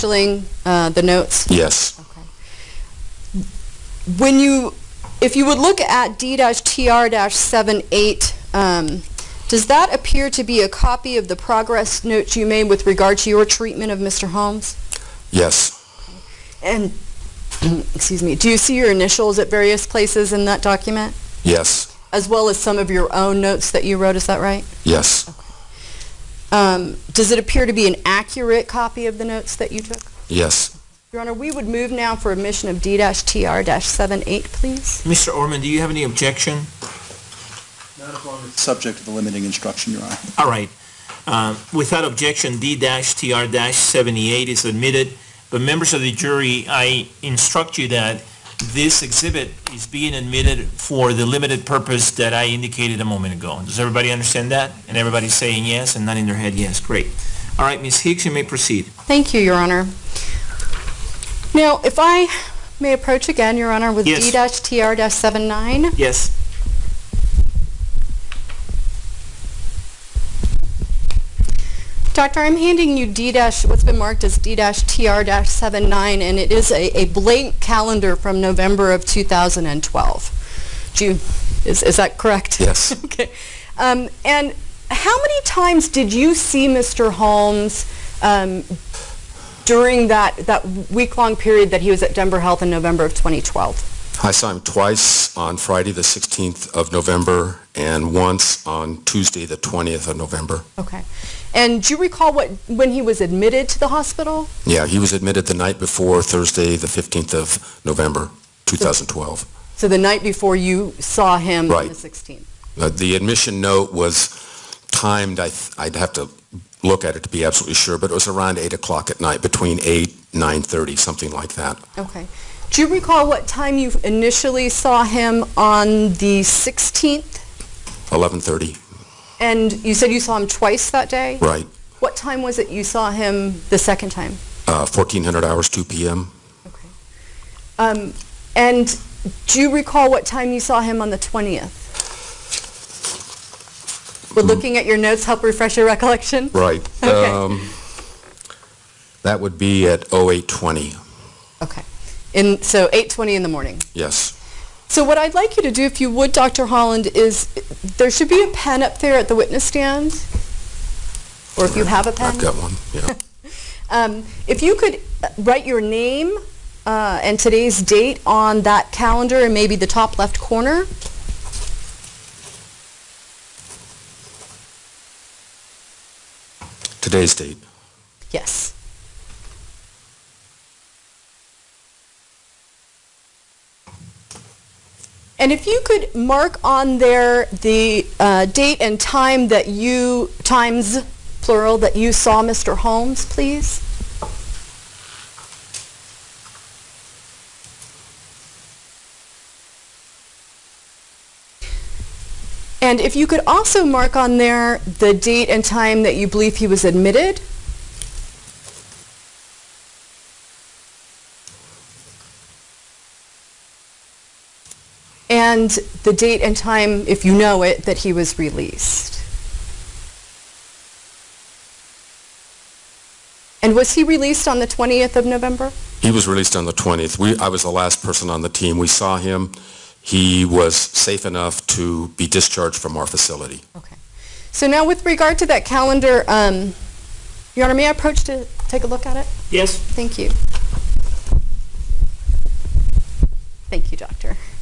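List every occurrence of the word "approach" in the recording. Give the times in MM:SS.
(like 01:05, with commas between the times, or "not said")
01:02, 03:57.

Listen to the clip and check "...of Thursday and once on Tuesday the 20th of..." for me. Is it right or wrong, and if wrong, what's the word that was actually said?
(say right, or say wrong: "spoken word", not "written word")
wrong: "November", not "Thursday".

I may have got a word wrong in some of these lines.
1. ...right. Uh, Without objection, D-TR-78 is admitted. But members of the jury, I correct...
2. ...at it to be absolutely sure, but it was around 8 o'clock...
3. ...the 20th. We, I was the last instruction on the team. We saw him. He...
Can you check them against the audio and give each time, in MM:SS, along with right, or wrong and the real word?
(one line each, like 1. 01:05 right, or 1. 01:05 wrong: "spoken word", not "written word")
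1. 00:40 wrong: "instruct", not "correct"
2. 01:57 right
3. 03:46 wrong: "person", not "instruction".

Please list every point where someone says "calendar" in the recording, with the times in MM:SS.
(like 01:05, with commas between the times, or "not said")
01:17, 02:48, 03:55.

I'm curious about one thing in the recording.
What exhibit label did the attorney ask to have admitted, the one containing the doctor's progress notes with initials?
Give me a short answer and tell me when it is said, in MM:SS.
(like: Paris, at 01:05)
D-TR-78, at 00:32.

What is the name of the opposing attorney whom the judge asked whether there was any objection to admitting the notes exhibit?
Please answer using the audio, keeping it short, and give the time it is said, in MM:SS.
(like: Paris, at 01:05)
Mr. Orman, at 00:35.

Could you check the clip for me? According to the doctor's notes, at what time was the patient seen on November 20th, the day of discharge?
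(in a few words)
08:20.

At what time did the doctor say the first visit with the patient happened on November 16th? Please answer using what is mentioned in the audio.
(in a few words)
11:30.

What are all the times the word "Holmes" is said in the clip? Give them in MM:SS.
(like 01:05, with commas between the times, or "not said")
00:14, 01:27, 03:12.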